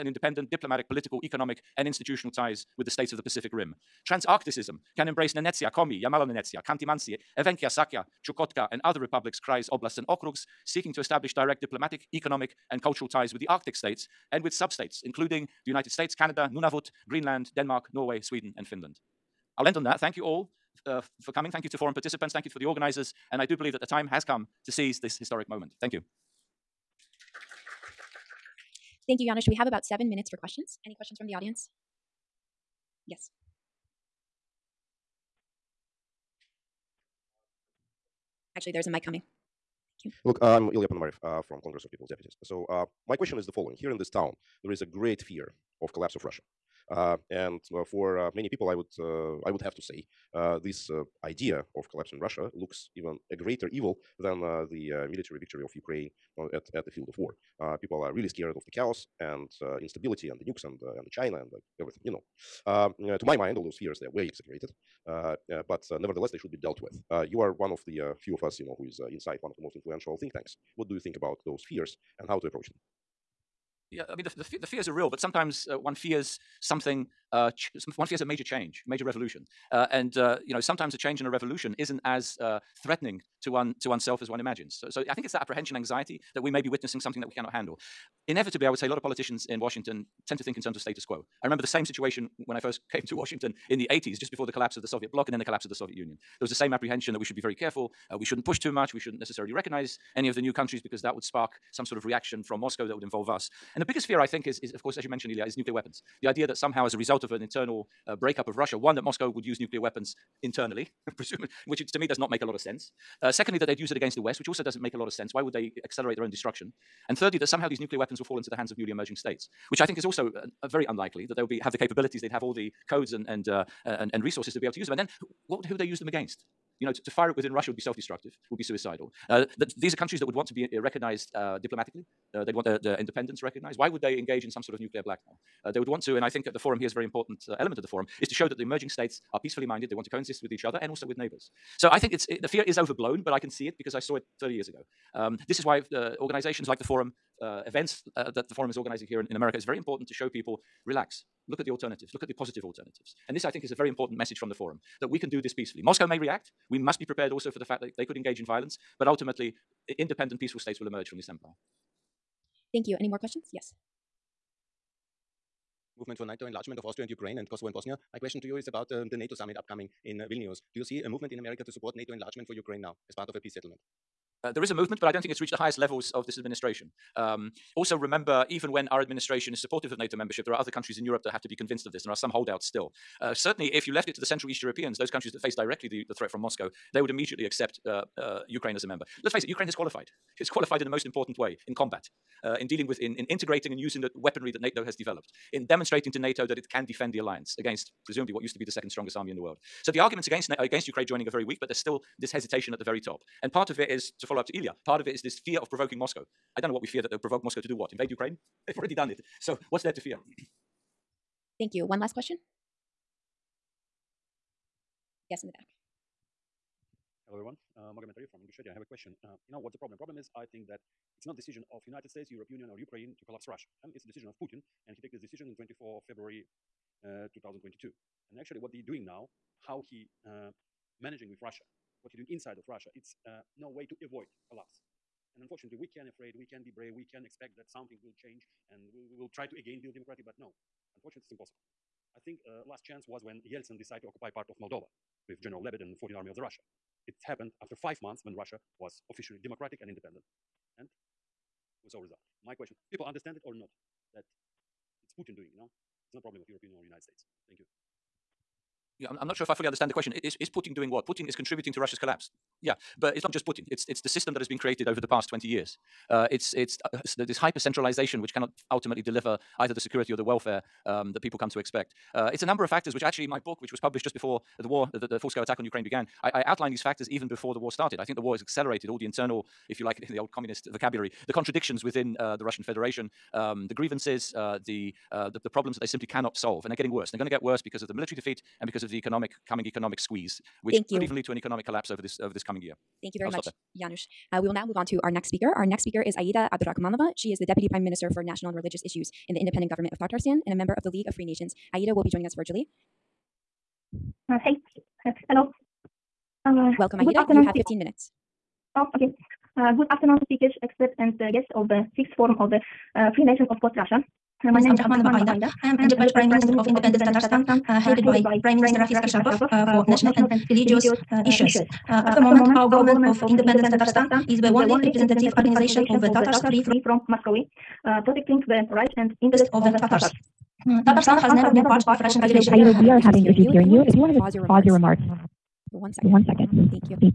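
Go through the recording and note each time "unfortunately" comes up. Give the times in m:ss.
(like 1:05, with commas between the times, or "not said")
3:55, 4:00.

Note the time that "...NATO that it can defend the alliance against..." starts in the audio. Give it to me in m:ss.
3:16.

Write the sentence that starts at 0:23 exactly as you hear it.
And I do believe that the time has come to seize this historic moment.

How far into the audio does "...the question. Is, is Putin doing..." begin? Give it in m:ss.
4:19.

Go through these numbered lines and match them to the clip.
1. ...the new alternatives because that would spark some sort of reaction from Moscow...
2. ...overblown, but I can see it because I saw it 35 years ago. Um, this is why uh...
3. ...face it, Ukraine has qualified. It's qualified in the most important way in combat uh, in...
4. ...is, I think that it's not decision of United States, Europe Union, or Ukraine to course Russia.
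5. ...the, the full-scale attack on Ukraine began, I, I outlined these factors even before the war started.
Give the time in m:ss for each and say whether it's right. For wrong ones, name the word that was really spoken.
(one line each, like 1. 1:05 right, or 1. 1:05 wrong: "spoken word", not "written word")
1. 1:40 wrong: "countries", not "alternatives"
2. 2:22 wrong: "30", not "35"
3. 3:09 right
4. 3:40 wrong: "collapse", not "course"
5. 4:34 right.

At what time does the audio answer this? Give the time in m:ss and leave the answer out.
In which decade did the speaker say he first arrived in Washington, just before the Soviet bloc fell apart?
1:33.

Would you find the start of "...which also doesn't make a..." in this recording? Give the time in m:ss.
1:54.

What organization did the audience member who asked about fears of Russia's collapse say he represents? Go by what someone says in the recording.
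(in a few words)
Congress of People's Deputies.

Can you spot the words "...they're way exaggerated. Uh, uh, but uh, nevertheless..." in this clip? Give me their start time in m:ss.
1:04.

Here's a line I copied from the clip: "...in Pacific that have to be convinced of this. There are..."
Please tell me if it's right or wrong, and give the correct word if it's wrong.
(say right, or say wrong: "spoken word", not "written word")
wrong: "Europe", not "Pacific".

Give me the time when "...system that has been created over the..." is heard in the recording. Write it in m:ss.
4:24.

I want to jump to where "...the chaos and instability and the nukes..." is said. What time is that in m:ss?
0:58.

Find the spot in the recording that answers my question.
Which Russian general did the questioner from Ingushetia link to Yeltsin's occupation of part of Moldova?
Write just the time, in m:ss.
4:05.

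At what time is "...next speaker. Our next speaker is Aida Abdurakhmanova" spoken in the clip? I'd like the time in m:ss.
4:55.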